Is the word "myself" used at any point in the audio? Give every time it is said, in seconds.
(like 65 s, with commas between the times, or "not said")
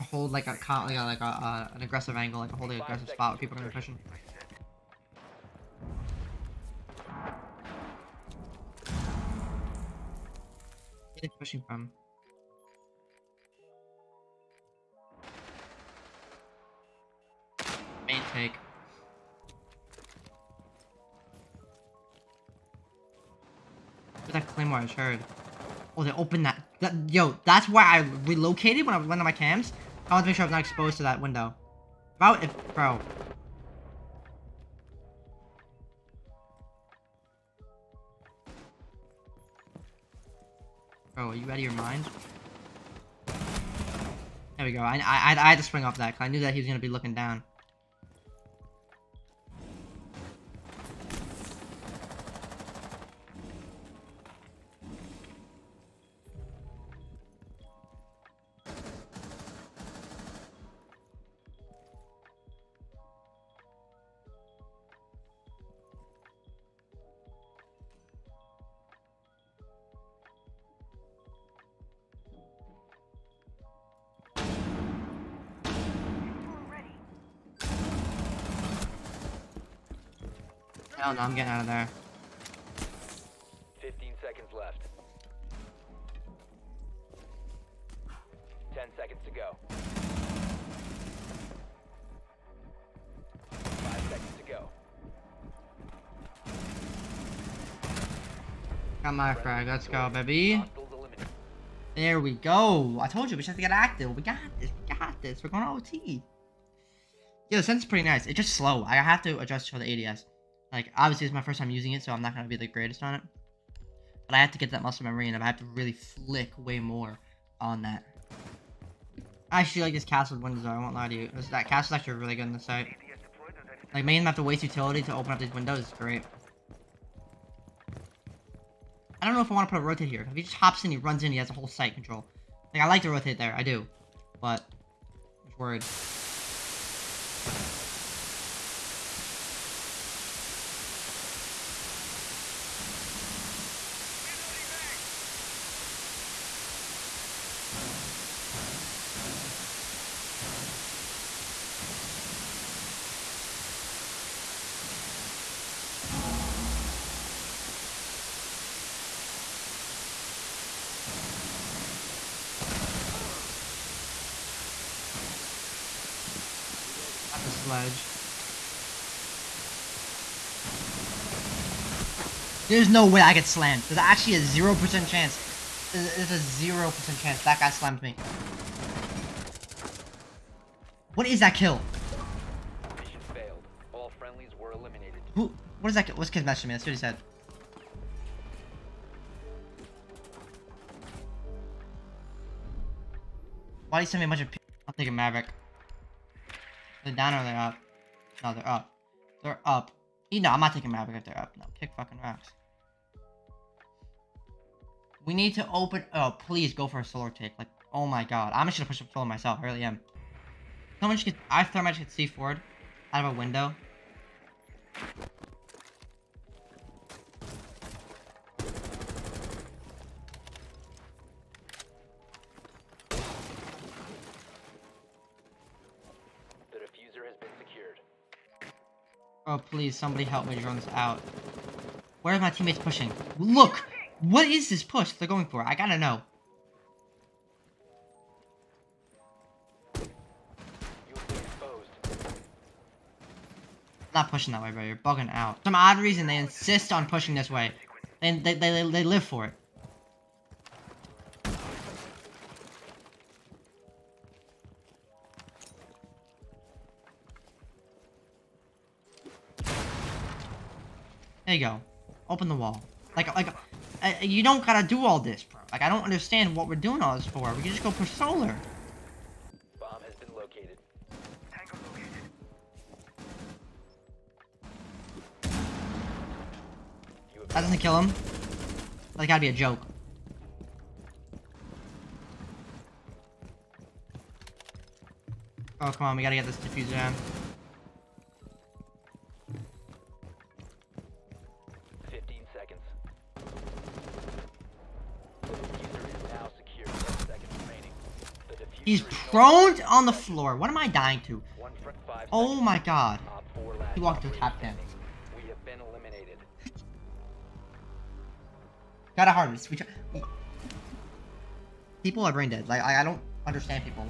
209 s.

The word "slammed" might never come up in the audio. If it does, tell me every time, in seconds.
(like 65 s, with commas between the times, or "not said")
173 s, 177 s.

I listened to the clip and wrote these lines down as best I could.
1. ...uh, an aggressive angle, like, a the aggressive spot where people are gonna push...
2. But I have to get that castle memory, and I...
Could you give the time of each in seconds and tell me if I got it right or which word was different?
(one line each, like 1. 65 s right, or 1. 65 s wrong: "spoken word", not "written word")
1. 1 s right
2. 114 s wrong: "muscle", not "castle".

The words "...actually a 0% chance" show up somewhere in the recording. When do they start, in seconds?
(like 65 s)
173 s.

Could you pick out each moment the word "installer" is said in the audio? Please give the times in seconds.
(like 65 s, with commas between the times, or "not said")
not said.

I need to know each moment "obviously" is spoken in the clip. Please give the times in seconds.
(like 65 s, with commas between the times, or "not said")
110 s.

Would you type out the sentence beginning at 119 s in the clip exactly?
I actually like this castle windows, though.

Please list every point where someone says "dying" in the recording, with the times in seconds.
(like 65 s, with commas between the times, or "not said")
300 s.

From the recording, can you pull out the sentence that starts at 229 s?
Oh, please, somebody help me this out.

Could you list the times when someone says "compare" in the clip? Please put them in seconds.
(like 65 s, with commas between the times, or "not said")
not said.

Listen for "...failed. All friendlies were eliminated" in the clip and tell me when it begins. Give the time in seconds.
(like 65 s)
183 s.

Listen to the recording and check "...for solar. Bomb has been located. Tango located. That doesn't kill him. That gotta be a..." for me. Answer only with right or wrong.
right.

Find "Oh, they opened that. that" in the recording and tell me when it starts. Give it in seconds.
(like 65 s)
25 s.